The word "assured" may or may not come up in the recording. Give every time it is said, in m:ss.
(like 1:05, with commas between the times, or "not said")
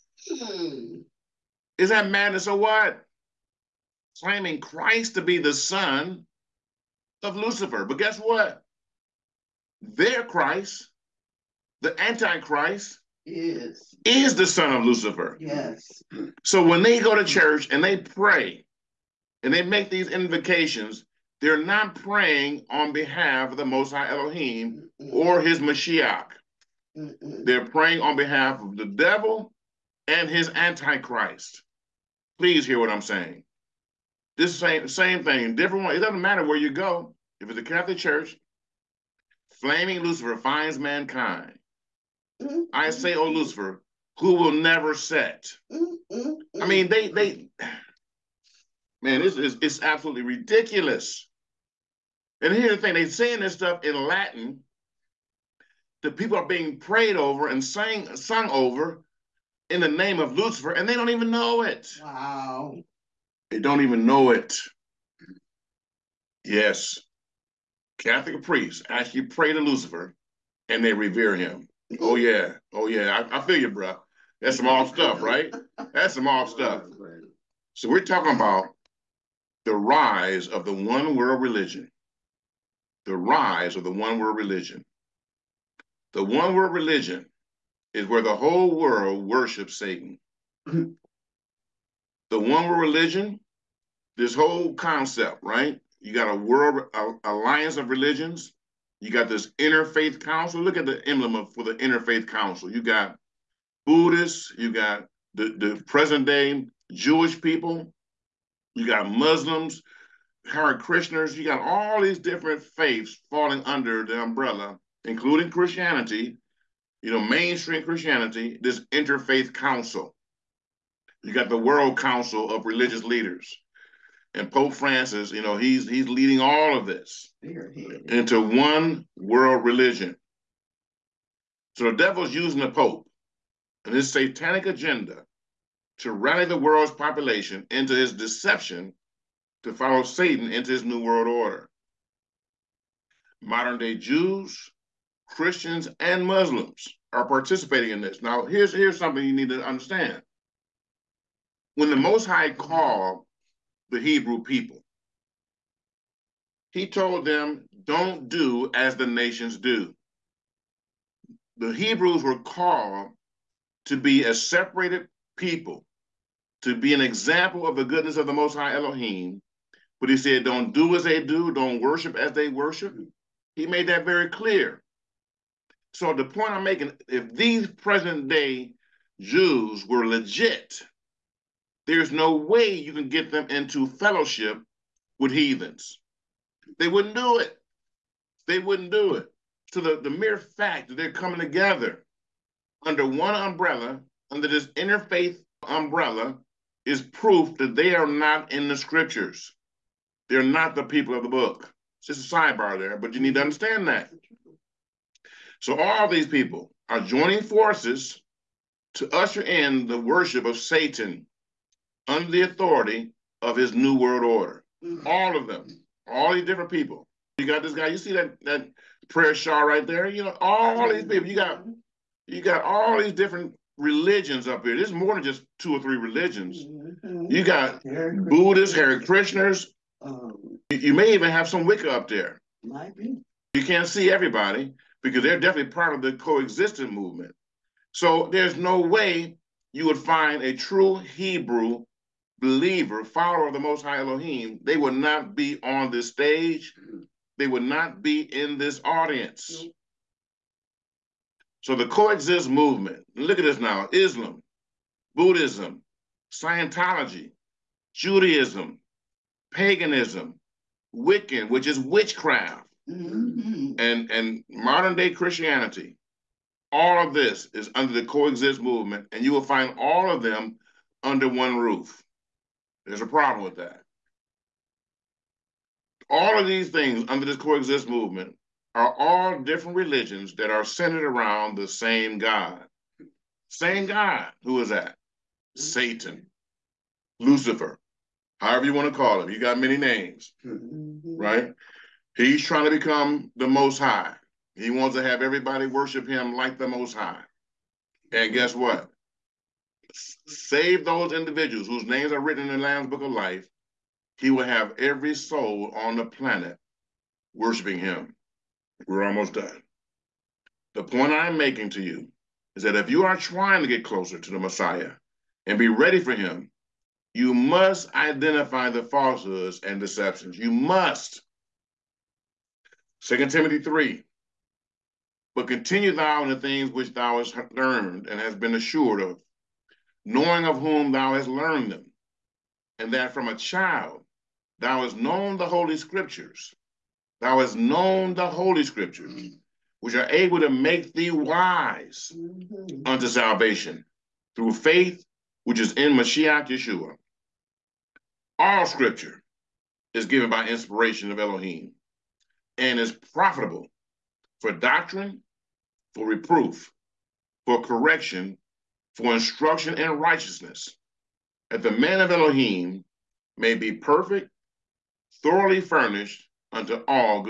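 5:28.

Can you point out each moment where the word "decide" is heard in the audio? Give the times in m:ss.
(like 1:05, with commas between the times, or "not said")
not said.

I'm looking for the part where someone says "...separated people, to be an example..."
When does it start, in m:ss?
2:44.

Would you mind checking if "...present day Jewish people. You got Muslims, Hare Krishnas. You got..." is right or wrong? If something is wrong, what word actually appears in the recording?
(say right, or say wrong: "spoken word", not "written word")
right.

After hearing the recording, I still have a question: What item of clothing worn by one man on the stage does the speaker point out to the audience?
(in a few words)
prayer shawl.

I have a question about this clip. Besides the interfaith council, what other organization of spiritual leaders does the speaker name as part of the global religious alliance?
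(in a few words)
World Council of Religious Leaders.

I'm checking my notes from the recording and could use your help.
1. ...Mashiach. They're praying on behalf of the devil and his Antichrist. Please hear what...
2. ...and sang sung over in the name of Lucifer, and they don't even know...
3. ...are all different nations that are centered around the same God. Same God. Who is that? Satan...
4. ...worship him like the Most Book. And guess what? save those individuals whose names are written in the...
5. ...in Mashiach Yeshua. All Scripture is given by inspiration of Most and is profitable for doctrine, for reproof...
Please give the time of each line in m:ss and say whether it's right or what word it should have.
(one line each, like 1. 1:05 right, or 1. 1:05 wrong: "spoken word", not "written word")
1. 0:25 right
2. 0:57 right
3. 4:38 wrong: "religions", not "nations"
4. 4:55 wrong: "High", not "Book"
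5. 5:45 wrong: "Elohim", not "Most".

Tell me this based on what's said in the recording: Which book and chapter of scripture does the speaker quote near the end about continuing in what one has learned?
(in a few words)
Second Timothy 3.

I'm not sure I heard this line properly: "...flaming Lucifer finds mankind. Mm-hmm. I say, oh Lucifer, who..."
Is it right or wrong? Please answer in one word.
right.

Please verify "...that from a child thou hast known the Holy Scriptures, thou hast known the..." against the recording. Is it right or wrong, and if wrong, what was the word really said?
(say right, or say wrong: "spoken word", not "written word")
right.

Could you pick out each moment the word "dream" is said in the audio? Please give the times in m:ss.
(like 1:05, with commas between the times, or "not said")
not said.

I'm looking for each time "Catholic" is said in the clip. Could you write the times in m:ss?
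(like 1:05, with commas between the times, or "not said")
0:37, 1:07.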